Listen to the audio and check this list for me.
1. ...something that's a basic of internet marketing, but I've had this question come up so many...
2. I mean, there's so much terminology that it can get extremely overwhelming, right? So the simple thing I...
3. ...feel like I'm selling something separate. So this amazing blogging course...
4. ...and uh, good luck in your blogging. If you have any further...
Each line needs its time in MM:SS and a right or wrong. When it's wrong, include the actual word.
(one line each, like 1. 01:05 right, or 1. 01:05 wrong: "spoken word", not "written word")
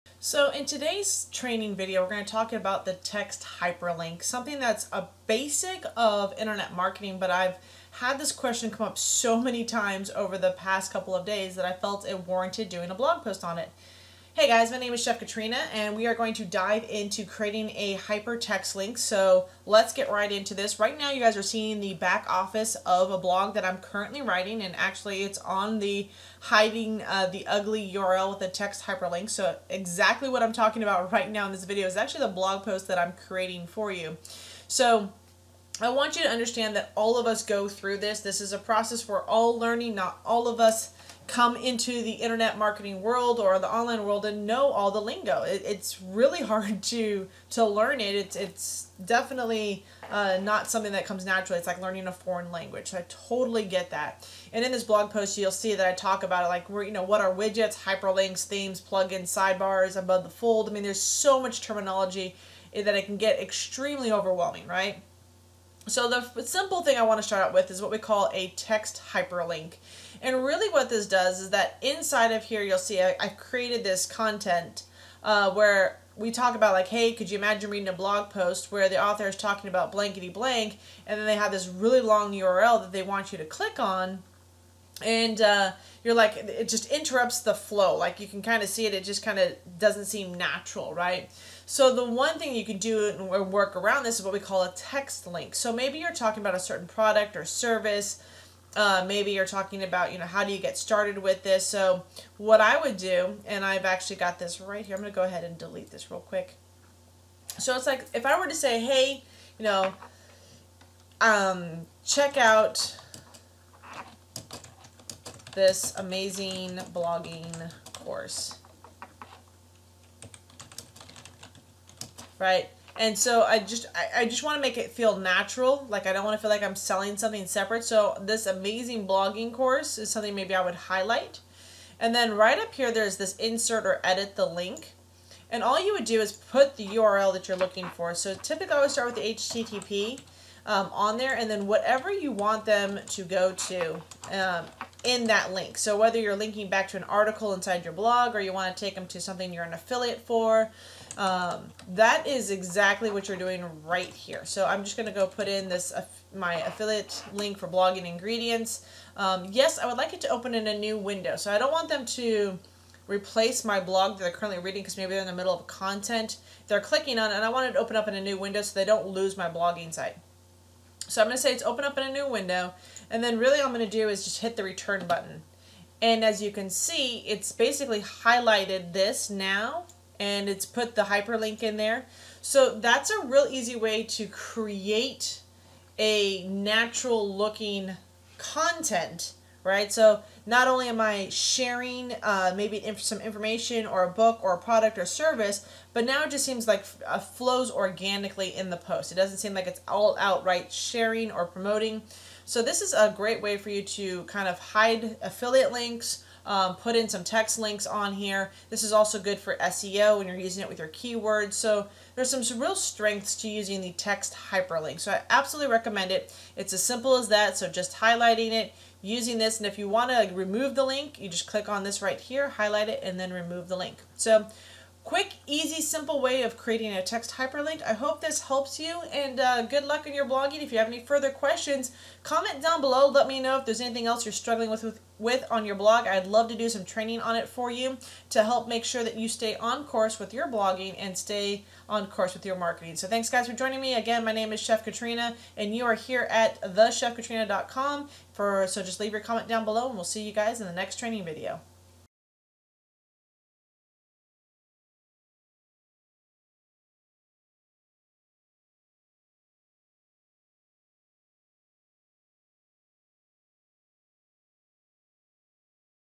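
1. 00:04 right
2. 01:00 right
3. 02:06 right
4. 03:49 right.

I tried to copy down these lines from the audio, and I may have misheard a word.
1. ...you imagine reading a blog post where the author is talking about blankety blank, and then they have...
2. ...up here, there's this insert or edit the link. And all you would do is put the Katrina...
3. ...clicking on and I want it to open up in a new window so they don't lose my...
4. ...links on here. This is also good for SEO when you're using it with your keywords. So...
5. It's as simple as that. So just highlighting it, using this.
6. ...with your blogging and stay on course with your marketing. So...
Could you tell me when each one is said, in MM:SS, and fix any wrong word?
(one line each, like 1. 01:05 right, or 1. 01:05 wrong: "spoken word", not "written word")
1. 01:17 right
2. 02:12 wrong: "URL", not "Katrina"
3. 02:46 right
4. 03:27 right
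5. 03:36 right
6. 04:00 right.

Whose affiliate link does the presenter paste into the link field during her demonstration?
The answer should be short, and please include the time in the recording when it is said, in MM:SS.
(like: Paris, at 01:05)
blogging ingredients, at 02:37.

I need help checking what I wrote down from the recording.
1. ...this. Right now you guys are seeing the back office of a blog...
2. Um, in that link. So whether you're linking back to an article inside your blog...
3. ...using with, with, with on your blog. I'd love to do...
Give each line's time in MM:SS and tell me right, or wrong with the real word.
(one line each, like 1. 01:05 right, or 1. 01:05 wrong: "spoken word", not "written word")
1. 00:20 right
2. 02:24 right
3. 03:54 wrong: "struggling", not "using".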